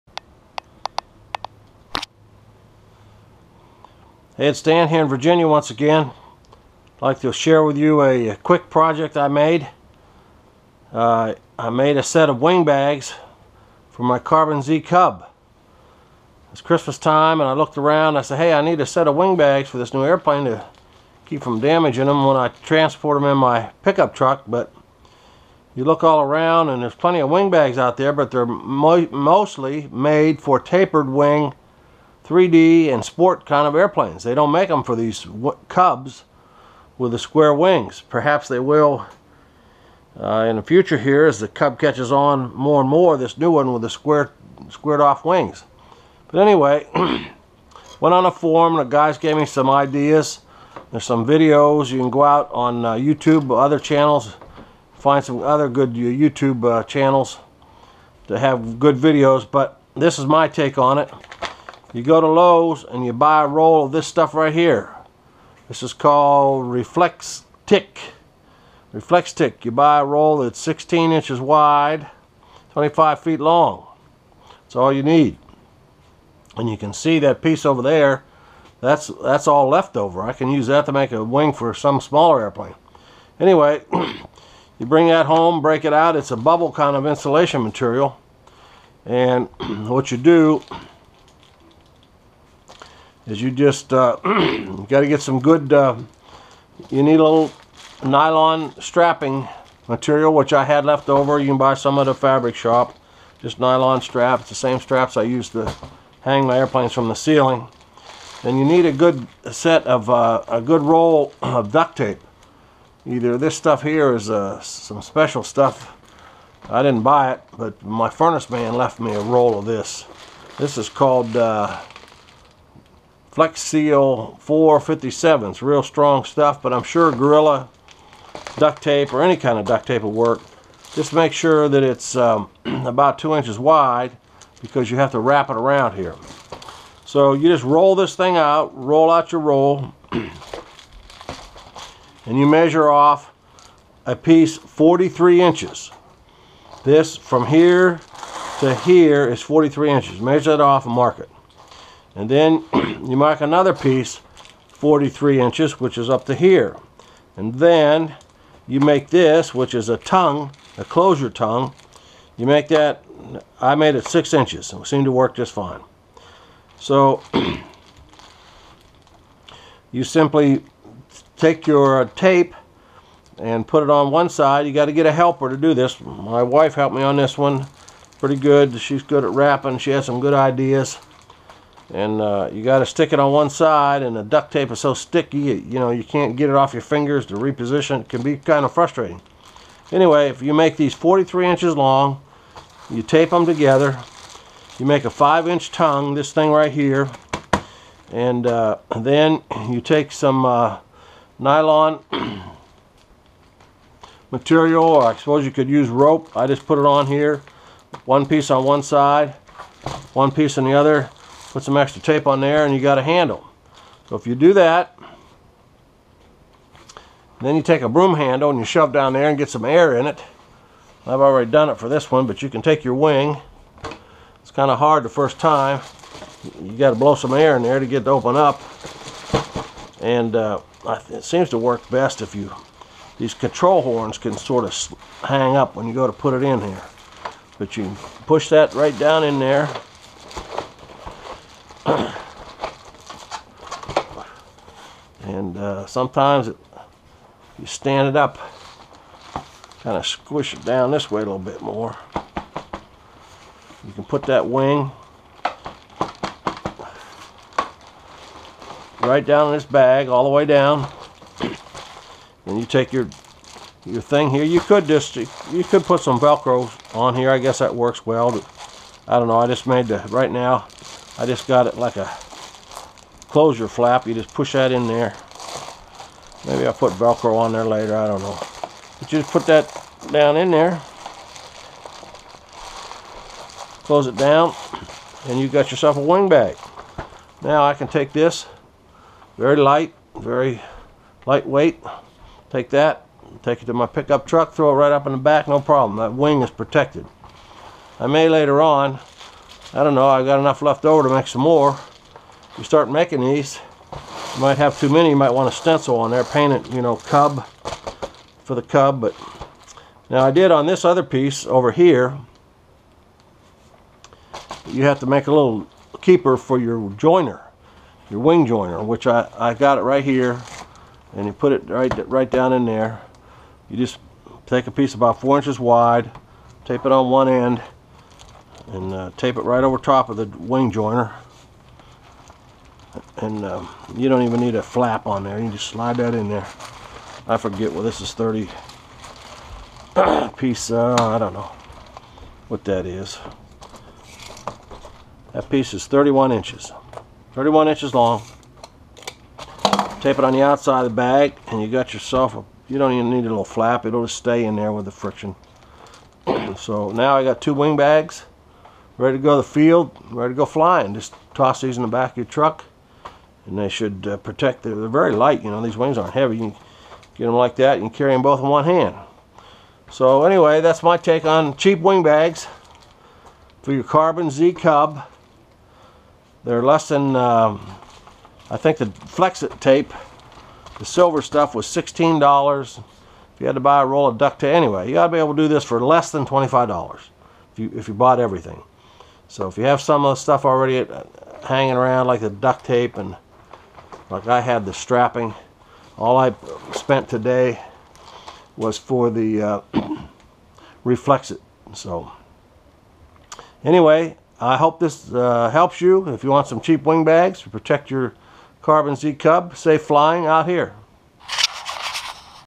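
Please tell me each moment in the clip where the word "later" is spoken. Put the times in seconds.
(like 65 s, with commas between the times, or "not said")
277 s, 298 s.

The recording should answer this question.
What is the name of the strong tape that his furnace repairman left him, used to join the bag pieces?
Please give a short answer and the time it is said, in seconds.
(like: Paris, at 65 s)
Flex Seal 457s, at 123 s.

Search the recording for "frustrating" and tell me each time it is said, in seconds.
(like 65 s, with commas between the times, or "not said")
188 s.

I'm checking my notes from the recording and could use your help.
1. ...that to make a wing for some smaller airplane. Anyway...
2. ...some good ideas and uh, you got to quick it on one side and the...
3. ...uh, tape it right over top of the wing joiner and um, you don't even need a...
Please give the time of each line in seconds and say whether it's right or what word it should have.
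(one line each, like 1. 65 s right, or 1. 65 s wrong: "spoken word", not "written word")
1. 80 s right
2. 180 s wrong: "stick", not "quick"
3. 328 s right.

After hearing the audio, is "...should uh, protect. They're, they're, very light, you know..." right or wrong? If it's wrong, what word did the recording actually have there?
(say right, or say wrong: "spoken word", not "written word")
right.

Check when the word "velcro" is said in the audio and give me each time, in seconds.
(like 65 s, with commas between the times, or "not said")
266 s, 276 s.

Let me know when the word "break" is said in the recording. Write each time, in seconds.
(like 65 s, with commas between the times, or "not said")
85 s.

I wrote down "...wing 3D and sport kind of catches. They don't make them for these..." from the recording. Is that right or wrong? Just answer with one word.
wrong.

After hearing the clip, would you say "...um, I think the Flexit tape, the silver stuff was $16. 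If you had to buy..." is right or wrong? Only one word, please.
right.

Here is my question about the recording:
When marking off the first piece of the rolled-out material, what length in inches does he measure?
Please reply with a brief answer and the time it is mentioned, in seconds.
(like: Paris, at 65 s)
43 inches, at 142 s.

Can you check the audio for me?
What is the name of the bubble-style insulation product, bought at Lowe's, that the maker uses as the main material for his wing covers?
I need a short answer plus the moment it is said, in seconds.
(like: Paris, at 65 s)
Reflex Tick, at 65 s.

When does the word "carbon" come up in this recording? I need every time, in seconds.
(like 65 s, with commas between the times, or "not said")
14 s, 373 s, 408 s.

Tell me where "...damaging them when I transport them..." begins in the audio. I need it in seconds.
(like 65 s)
21 s.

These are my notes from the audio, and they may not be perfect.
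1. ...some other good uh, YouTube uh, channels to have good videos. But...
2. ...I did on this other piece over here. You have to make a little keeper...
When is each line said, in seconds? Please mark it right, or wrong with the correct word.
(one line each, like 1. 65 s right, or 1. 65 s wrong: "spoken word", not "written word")
1. 55 s right
2. 310 s right.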